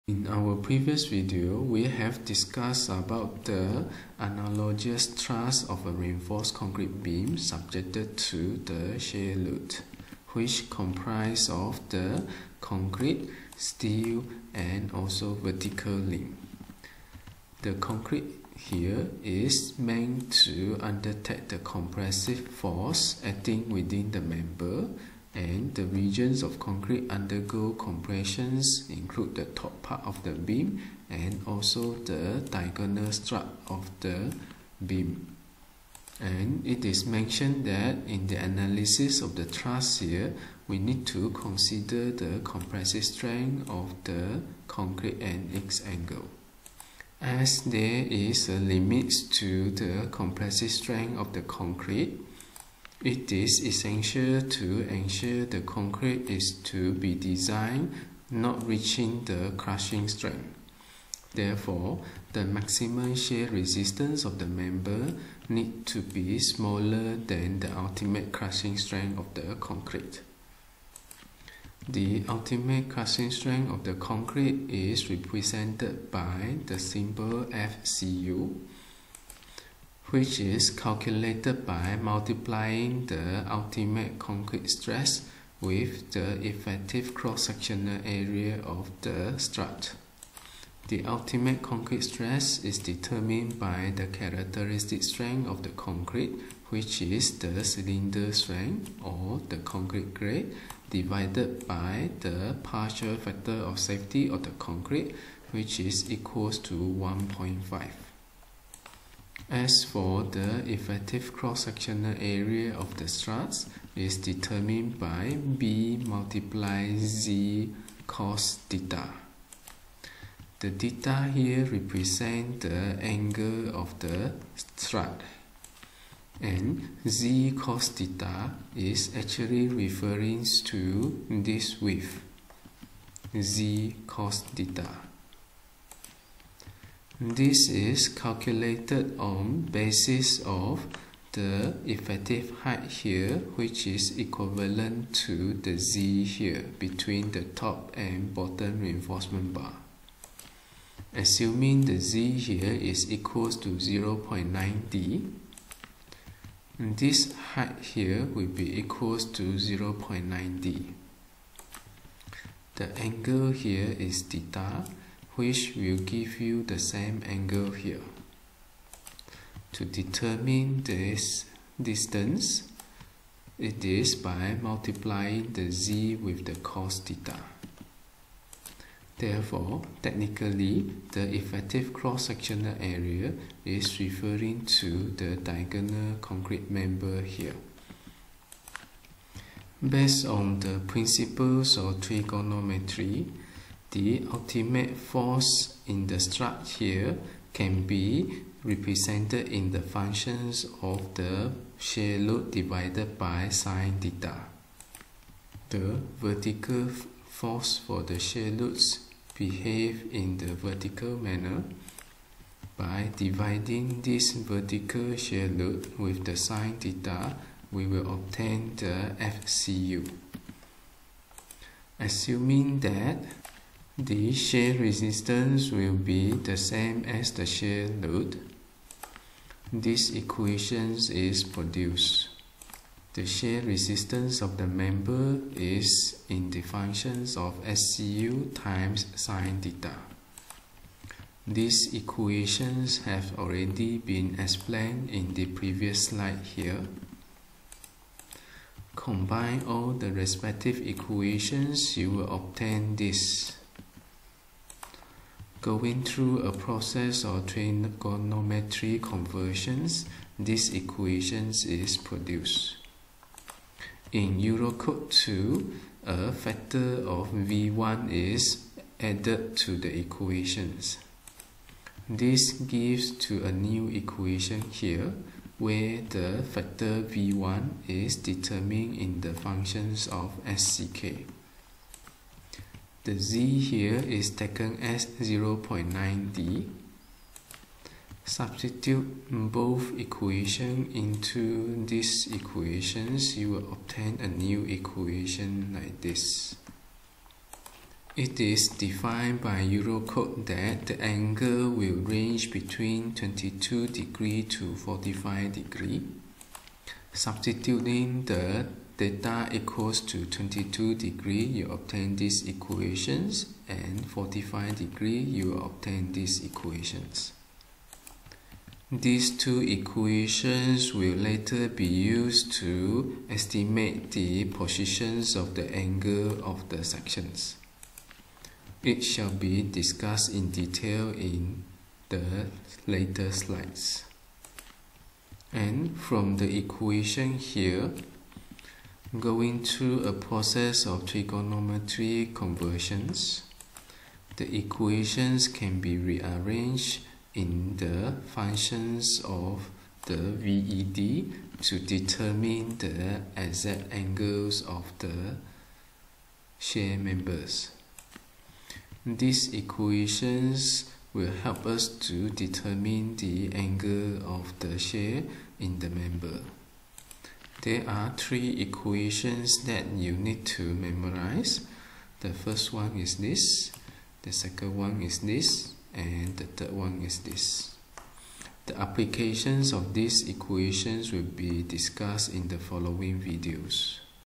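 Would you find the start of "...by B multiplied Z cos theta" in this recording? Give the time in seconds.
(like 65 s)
114 s.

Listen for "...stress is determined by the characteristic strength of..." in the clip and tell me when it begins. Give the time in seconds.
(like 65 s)
92 s.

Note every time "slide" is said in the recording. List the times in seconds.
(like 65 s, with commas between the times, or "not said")
246 s, 333 s.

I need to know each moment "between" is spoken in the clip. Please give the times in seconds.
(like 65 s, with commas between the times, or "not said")
146 s, 302 s.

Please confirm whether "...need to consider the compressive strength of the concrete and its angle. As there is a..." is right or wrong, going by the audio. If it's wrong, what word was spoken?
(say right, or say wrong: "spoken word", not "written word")
right.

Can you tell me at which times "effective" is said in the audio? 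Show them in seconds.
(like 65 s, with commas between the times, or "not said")
86 s, 110 s, 141 s, 181 s.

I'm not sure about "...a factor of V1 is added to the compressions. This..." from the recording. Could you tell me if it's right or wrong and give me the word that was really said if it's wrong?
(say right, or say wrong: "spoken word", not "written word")
wrong: "equations", not "compressions".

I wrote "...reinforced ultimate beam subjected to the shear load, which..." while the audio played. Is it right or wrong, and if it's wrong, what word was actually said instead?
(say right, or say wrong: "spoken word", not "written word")
wrong: "concrete", not "ultimate".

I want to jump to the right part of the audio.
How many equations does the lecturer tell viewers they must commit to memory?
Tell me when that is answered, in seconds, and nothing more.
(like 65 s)
368 s.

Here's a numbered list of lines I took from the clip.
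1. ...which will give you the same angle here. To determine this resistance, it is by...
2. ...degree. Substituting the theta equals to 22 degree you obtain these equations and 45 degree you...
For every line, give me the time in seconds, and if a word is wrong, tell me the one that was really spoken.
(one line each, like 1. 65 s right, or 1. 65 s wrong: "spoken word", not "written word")
1. 165 s wrong: "distance", not "resistance"
2. 305 s right.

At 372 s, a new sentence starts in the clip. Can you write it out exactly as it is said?
The first one is this, the second one is this, and the third one is this.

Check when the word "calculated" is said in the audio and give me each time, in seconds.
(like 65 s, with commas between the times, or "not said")
80 s, 138 s.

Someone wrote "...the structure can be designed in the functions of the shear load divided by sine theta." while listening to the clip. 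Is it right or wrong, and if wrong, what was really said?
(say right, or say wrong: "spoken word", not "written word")
wrong: "represented", not "designed".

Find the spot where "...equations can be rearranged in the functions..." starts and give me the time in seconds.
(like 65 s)
344 s.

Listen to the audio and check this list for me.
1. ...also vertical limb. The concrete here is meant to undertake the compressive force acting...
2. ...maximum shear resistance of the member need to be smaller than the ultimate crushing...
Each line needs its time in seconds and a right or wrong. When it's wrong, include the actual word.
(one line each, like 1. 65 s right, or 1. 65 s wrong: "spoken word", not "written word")
1. 14 s right
2. 62 s right.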